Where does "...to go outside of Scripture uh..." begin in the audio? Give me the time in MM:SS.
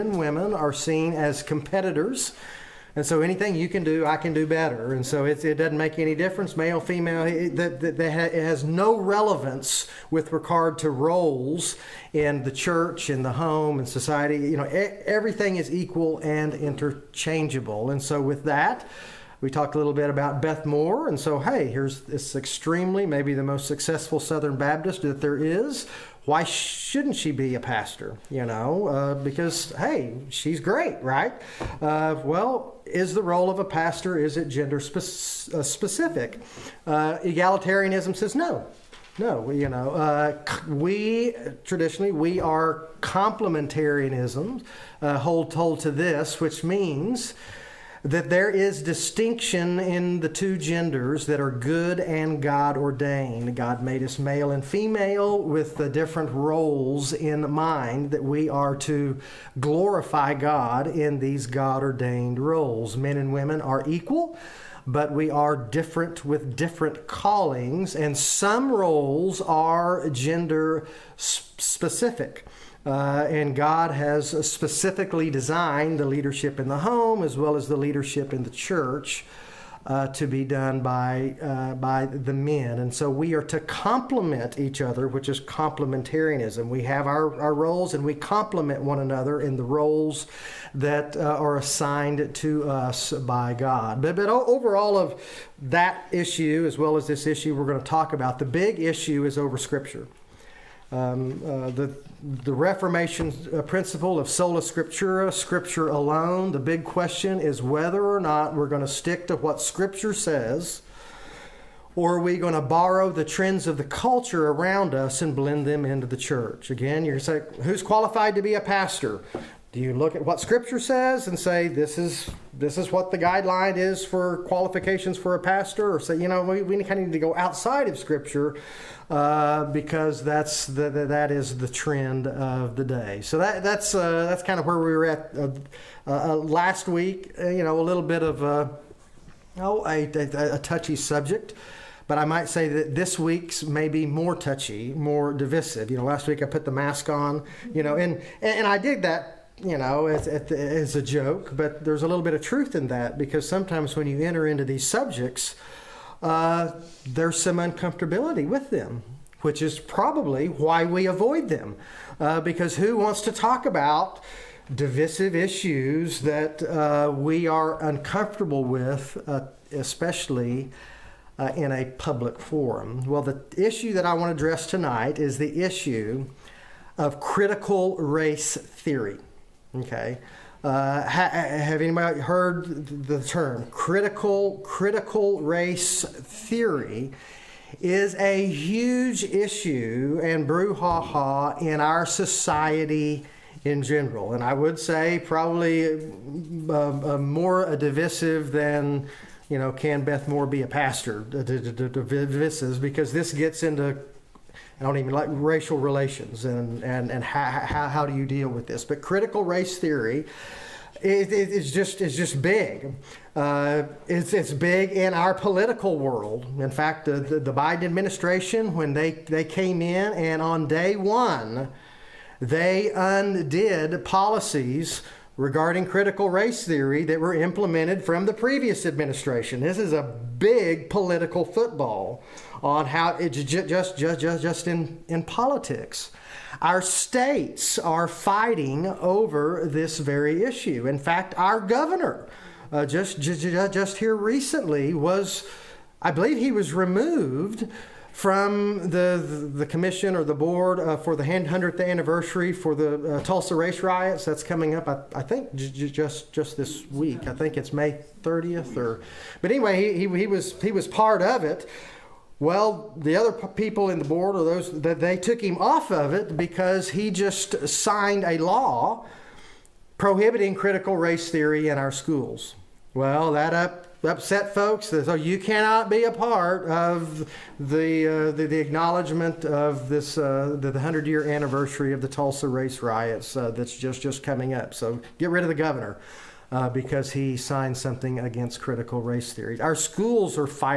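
02:07.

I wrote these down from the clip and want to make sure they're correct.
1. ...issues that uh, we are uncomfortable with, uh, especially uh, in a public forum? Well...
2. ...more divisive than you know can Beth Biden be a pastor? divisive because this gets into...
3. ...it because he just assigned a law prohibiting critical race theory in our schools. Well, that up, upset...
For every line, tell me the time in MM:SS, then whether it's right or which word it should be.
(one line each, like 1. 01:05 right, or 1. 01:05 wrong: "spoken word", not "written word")
1. 02:45 right
2. 03:17 wrong: "Moore", not "Biden"
3. 04:26 wrong: "signed", not "assigned".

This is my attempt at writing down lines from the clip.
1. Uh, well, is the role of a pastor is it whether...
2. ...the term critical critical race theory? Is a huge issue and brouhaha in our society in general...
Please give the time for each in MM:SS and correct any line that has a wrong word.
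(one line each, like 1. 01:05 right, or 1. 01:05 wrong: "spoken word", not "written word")
1. 00:31 wrong: "gender", not "whether"
2. 03:03 right.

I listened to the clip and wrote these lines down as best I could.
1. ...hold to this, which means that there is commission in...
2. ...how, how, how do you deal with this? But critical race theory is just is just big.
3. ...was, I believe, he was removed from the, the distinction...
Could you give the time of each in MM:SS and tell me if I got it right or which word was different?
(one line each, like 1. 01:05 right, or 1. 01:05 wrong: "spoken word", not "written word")
1. 00:45 wrong: "distinction", not "commission"
2. 03:27 right
3. 04:04 wrong: "commission", not "distinction".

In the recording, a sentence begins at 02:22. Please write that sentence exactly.
But I might say that this week's may be more touchy, more divisive.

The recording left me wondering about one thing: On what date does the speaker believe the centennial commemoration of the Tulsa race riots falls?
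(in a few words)
May 30th.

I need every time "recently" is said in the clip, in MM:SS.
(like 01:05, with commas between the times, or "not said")
04:04.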